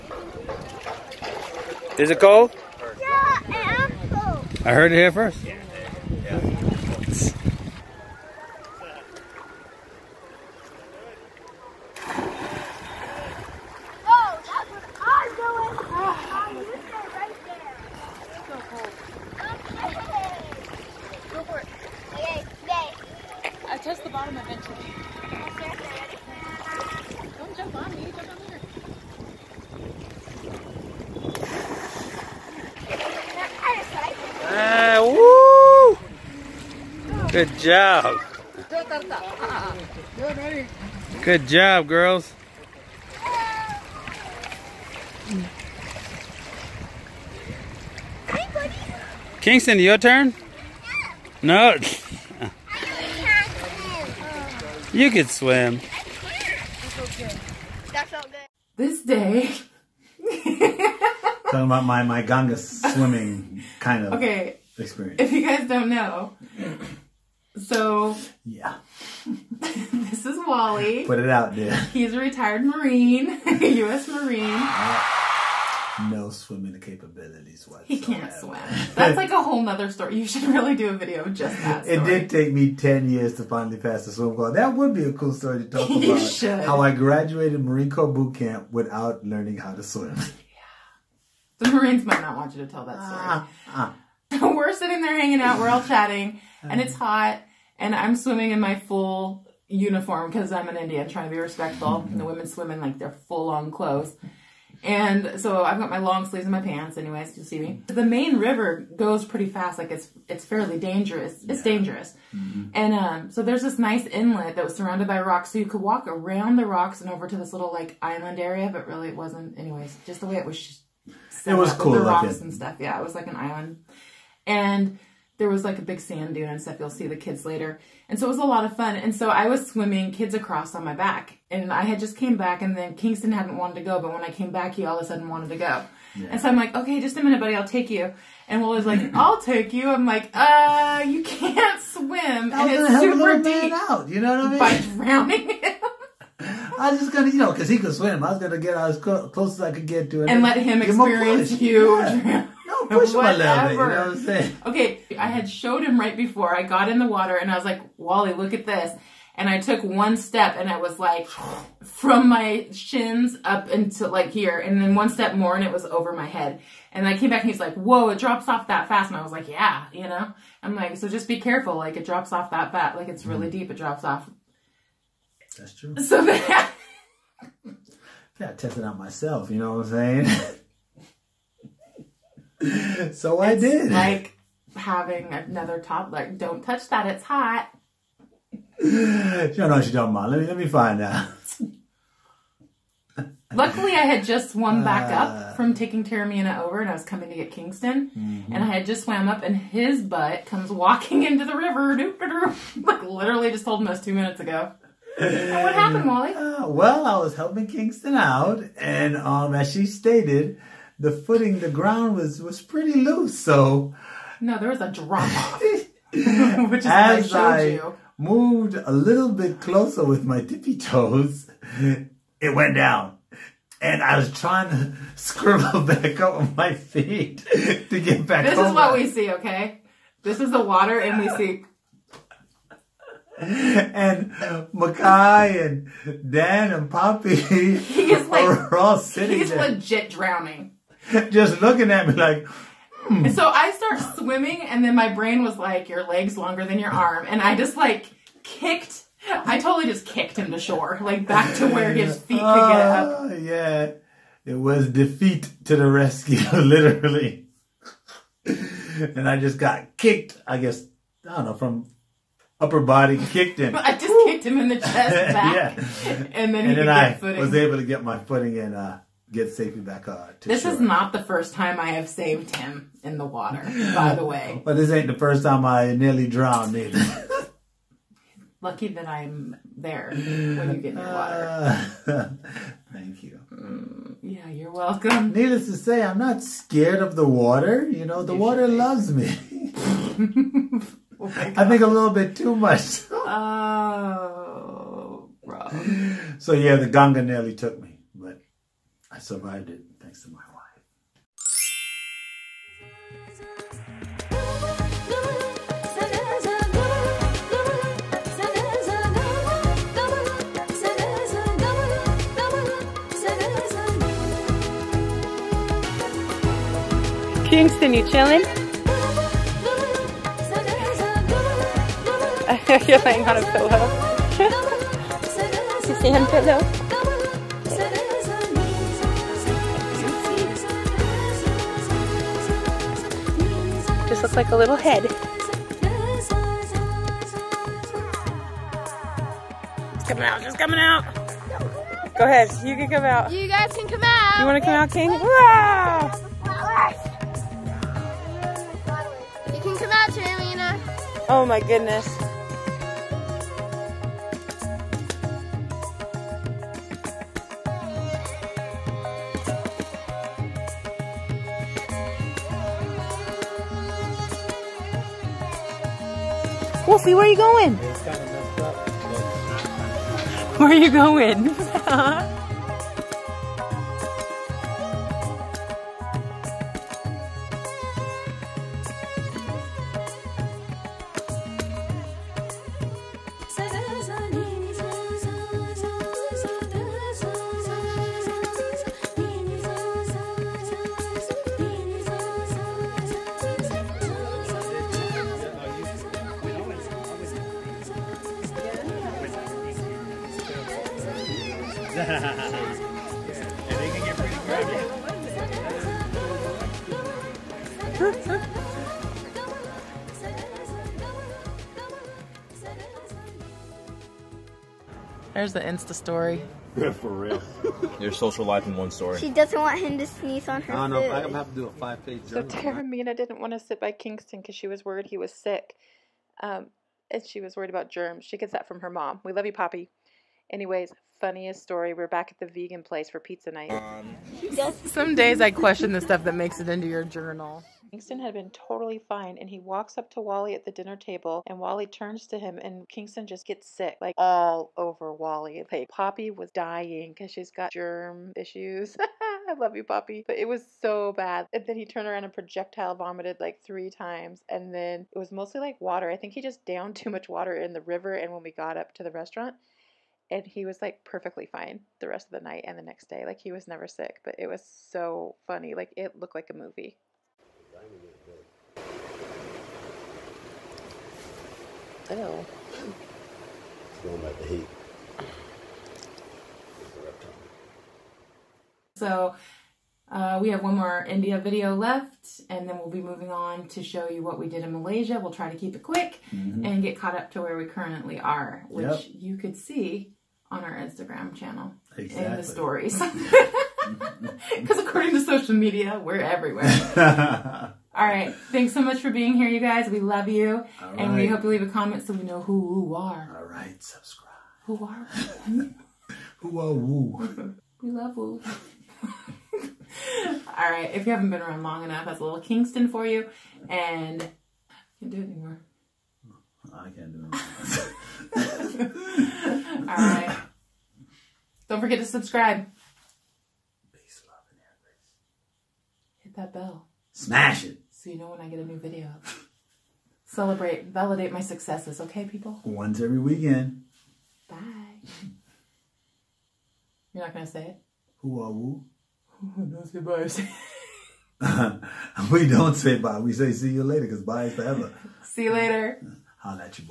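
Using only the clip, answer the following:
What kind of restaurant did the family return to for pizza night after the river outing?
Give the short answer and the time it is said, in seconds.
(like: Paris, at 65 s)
Vegan place, at 432 s.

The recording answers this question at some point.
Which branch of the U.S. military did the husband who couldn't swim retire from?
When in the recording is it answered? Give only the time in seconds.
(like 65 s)
72 s.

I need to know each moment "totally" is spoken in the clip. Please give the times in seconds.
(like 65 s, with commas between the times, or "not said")
249 s, 438 s.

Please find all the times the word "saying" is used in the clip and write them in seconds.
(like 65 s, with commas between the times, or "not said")
154 s, 180 s.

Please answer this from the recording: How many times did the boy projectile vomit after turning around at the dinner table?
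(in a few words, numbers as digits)
3.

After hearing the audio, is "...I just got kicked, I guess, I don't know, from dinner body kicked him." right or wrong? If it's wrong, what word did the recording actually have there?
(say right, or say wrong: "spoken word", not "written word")
wrong: "upper", not "dinner".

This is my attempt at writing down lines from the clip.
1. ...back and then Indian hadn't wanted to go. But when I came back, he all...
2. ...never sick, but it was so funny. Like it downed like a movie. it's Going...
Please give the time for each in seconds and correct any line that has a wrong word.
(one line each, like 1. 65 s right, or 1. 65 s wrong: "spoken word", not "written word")
1. 132 s wrong: "Kingston", not "Indian"
2. 463 s wrong: "looked", not "downed".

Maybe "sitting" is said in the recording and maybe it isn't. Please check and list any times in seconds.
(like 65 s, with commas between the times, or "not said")
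94 s, 238 s.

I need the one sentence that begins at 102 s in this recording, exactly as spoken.
And the women swim in like their full on clothes.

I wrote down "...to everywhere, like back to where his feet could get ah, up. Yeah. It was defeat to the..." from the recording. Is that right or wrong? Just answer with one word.
wrong.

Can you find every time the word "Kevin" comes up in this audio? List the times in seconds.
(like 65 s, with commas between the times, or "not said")
not said.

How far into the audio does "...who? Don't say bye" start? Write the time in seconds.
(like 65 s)
539 s.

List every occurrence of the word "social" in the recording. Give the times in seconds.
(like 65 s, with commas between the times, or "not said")
418 s, 495 s.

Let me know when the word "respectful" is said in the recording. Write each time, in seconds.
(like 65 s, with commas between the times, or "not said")
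101 s.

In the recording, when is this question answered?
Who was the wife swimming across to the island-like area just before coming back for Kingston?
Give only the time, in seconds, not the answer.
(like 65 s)
196 s.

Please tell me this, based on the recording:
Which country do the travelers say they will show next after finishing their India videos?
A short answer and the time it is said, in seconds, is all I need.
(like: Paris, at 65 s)
Malaysia, at 484 s.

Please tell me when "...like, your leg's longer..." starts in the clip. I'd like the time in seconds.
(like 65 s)
245 s.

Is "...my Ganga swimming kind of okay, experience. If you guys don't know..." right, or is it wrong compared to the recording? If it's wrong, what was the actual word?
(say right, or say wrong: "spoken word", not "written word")
right.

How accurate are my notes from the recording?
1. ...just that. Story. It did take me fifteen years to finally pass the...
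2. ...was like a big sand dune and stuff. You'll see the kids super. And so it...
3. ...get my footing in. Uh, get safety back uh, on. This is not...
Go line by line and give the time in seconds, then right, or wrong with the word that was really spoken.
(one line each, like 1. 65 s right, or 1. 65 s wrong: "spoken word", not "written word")
1. 81 s wrong: "ten", not "fifteen"
2. 125 s wrong: "later", not "super"
3. 267 s right.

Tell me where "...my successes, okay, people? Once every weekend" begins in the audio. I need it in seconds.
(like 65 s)
531 s.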